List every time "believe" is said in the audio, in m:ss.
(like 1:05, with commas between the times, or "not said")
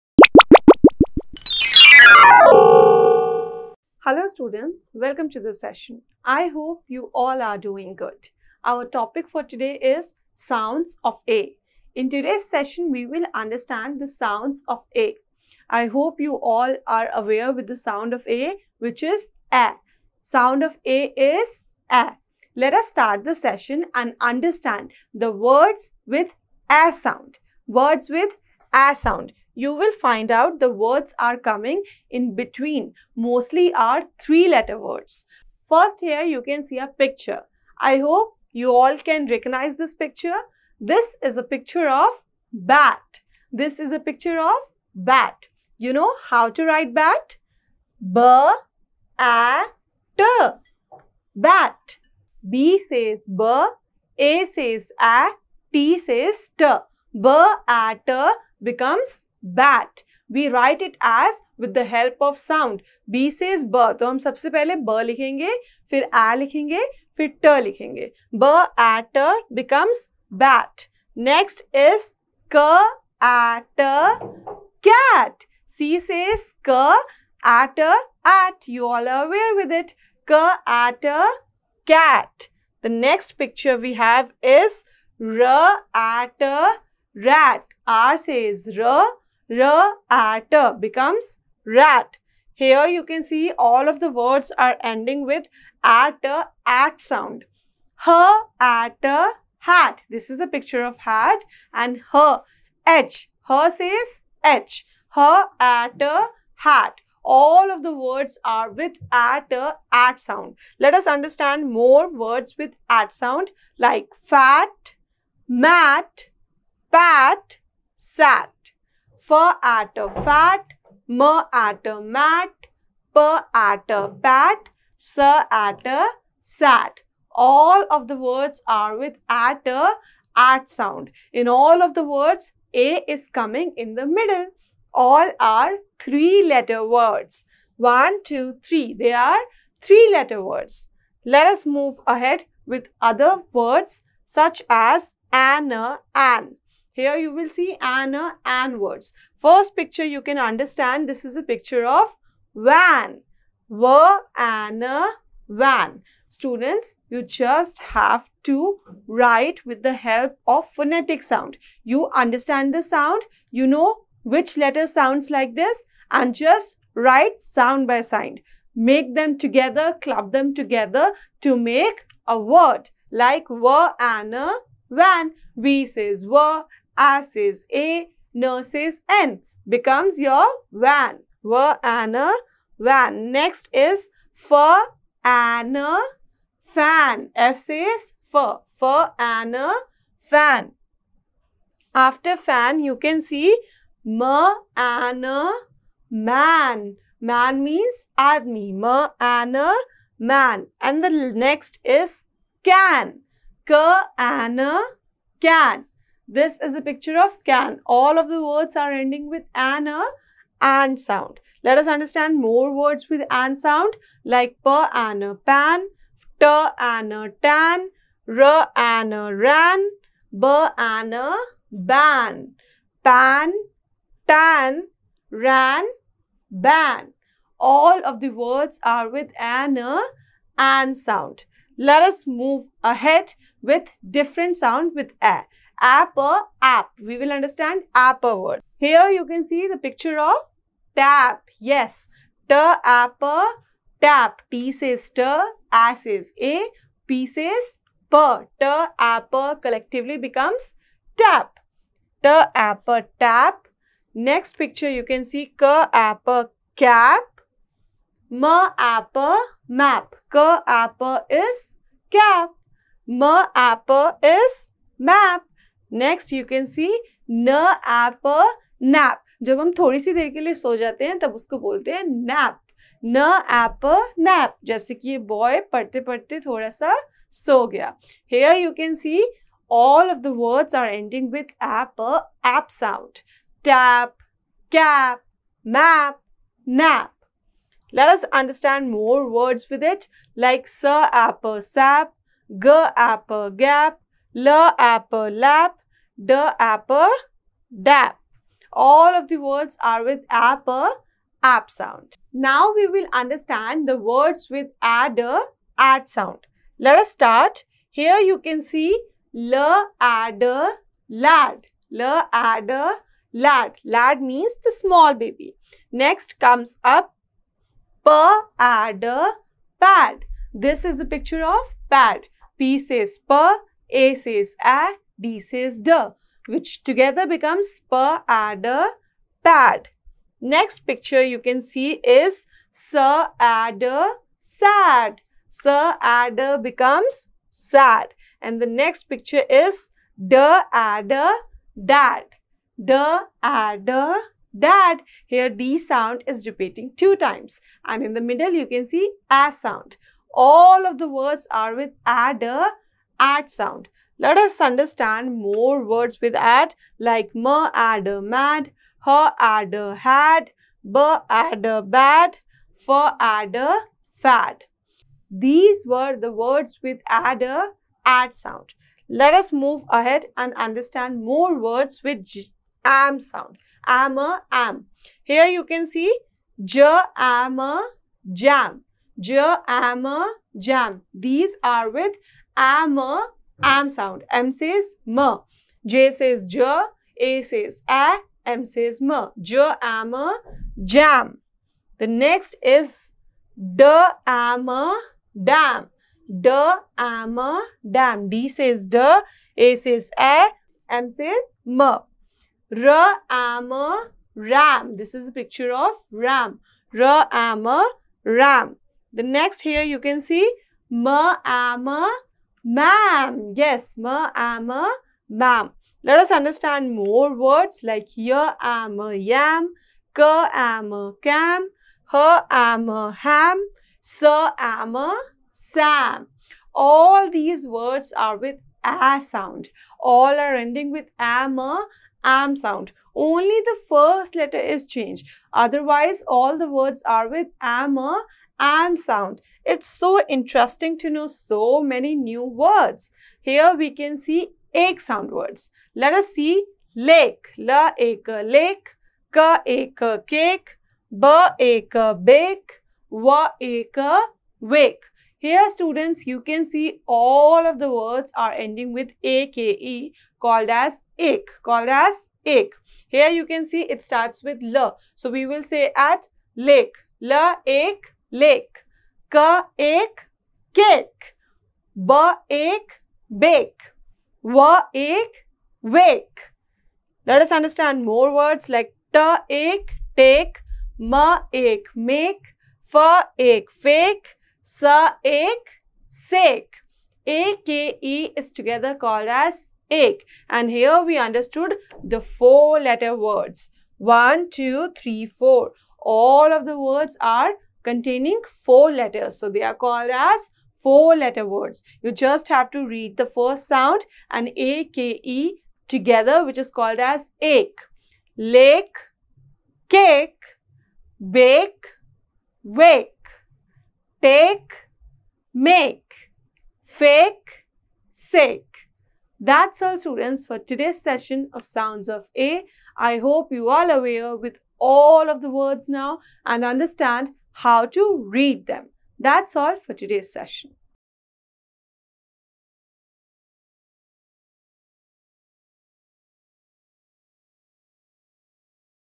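not said.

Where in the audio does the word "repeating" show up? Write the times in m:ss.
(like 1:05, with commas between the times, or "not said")
5:46.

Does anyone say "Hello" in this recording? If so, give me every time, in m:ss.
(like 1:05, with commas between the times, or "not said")
0:04.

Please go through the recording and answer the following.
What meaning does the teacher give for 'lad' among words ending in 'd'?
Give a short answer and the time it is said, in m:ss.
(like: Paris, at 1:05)
the small baby, at 5:13.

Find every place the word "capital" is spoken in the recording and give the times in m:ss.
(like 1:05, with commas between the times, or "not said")
not said.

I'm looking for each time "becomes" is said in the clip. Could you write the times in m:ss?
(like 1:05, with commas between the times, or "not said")
0:58, 1:09, 1:30, 2:59, 4:10, 5:27, 5:36.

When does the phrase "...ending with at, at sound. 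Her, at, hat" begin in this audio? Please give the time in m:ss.
1:34.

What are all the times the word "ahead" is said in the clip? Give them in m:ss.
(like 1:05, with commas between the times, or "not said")
2:22, 3:52, 6:09.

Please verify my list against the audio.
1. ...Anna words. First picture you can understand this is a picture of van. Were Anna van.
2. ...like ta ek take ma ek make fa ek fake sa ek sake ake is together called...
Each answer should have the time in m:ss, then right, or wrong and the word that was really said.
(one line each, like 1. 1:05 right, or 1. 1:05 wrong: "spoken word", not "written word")
1. 2:27 right
2. 7:58 right.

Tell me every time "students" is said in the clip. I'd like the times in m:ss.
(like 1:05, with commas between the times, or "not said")
0:04, 2:36, 7:35, 8:39.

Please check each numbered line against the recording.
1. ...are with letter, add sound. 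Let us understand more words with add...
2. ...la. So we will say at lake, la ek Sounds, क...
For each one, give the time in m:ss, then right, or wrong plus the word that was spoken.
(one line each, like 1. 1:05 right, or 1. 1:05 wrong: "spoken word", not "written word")
1. 5:51 wrong: "adder", not "letter"
2. 7:44 wrong: "Lake", not "Sounds".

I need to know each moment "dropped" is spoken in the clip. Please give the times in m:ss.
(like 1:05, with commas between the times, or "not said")
not said.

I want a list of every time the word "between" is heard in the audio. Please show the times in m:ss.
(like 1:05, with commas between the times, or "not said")
0:32.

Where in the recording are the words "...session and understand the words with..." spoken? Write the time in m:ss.
0:23.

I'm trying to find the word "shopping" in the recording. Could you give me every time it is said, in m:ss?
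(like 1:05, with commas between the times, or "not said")
not said.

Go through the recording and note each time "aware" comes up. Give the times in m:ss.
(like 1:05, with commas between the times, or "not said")
0:17, 1:19, 8:43.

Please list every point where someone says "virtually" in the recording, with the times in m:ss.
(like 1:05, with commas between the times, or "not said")
not said.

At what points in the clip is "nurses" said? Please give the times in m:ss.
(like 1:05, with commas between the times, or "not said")
2:58.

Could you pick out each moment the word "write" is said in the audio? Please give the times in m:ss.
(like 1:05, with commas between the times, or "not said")
0:46, 1:00, 2:39, 2:46.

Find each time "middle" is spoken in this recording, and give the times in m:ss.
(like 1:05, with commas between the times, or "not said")
2:14, 5:48.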